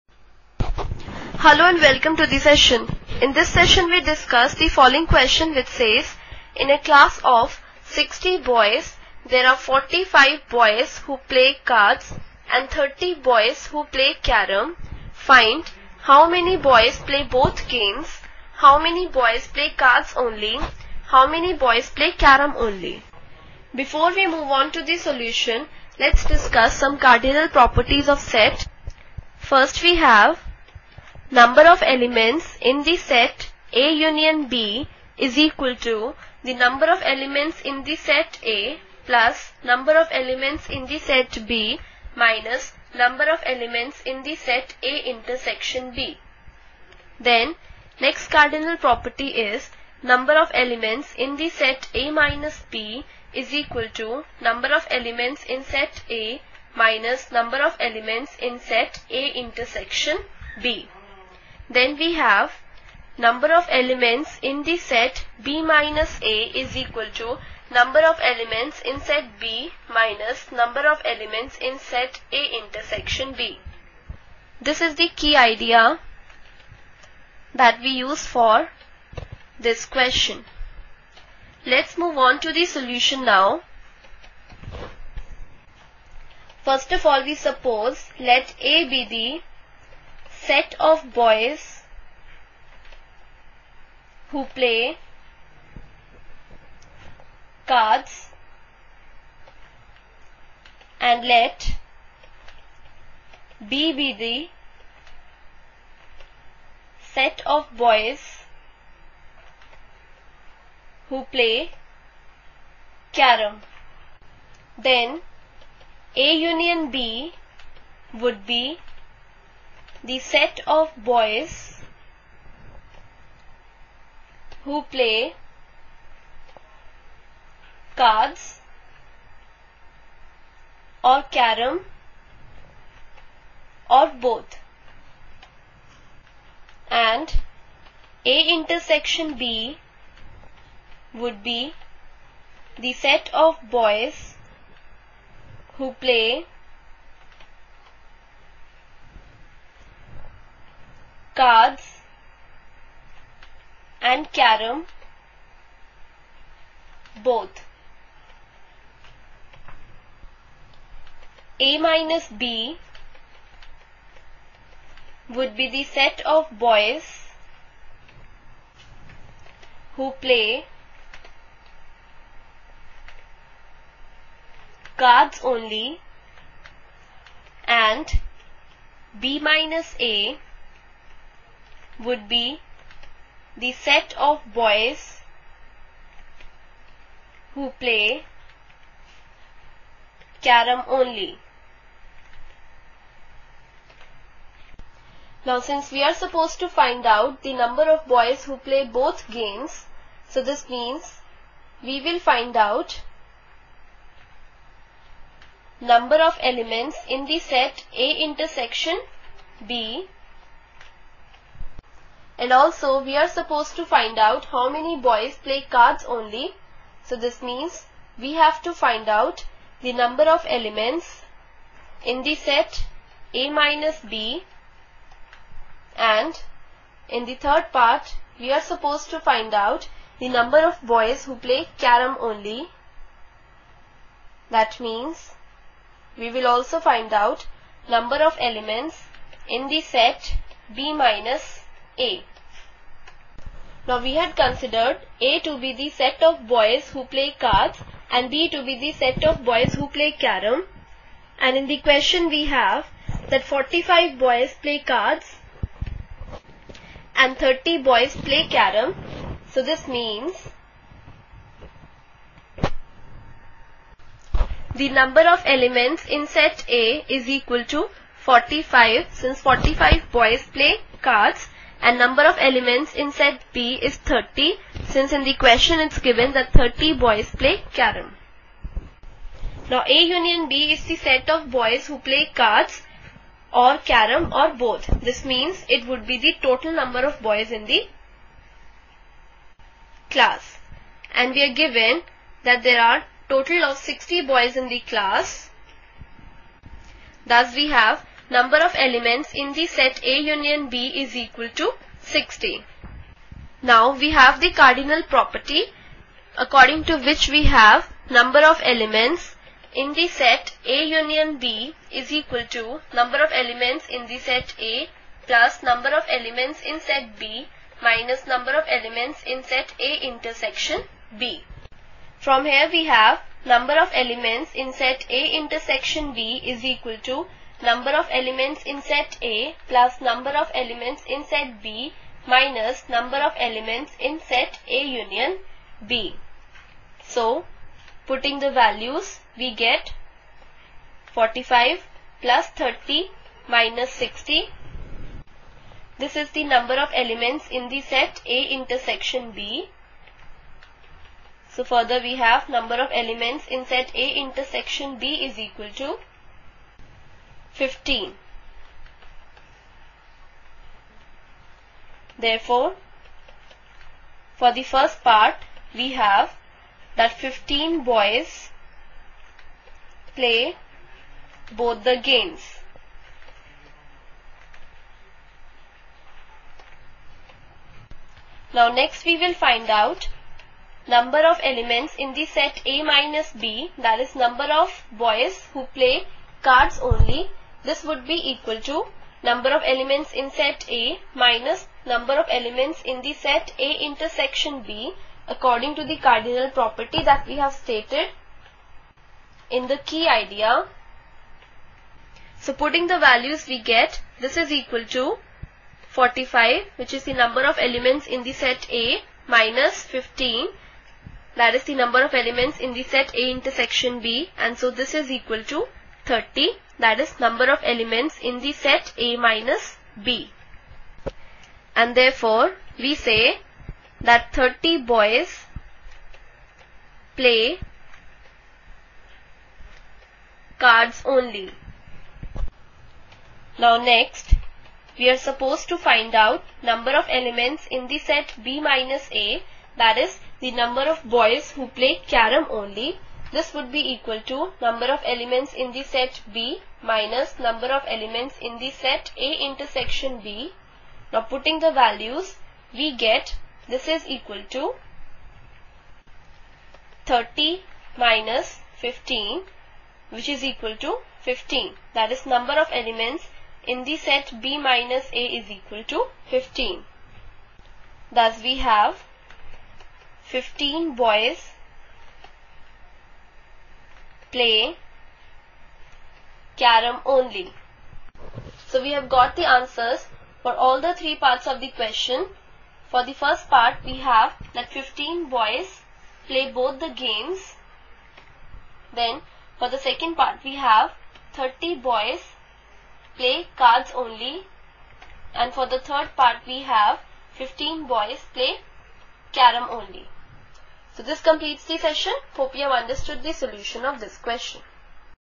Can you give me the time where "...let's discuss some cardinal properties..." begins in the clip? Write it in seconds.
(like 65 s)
25 s.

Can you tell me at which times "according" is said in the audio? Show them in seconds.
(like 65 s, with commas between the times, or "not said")
306 s, 395 s.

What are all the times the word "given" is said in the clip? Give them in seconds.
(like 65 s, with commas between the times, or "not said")
275 s, 291 s.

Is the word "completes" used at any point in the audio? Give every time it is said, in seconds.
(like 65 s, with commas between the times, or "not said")
501 s.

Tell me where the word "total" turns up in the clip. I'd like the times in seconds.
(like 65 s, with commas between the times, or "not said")
286 s, 293 s.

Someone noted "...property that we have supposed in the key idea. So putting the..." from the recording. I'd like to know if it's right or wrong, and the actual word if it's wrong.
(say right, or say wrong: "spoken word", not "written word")
wrong: "stated", not "supposed".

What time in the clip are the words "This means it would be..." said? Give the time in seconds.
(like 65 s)
285 s.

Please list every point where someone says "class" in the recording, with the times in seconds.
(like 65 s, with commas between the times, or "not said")
6 s, 290 s, 294 s.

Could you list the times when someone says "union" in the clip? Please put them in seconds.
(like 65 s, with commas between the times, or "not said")
33 s, 116 s, 280 s, 300 s, 310 s, 334 s.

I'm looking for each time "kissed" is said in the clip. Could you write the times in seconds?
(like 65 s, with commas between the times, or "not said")
not said.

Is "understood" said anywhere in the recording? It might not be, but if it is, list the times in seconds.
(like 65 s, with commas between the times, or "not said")
502 s.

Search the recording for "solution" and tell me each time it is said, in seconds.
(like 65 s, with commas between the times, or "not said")
24 s, 82 s, 503 s.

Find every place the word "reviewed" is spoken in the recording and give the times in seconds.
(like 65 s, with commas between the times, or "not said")
not said.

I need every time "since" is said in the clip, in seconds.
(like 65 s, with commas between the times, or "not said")
195 s, 269 s, 274 s.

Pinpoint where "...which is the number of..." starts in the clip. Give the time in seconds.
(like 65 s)
406 s.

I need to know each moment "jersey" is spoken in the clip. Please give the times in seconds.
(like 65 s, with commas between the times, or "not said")
not said.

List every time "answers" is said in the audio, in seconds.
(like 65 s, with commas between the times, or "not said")
479 s.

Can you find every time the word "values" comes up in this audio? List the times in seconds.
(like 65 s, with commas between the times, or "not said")
338 s, 402 s, 451 s.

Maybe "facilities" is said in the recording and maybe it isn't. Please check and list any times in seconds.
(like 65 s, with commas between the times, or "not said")
not said.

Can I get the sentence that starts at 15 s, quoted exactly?
Find how many boys play both games, how many boys play cards only, how many boys play carom only.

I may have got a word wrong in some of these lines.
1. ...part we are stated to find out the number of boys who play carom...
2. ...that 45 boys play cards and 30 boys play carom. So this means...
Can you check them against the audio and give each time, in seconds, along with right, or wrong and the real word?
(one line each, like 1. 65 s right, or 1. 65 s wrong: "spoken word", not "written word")
1. 227 s wrong: "supposed", not "stated"
2. 253 s right.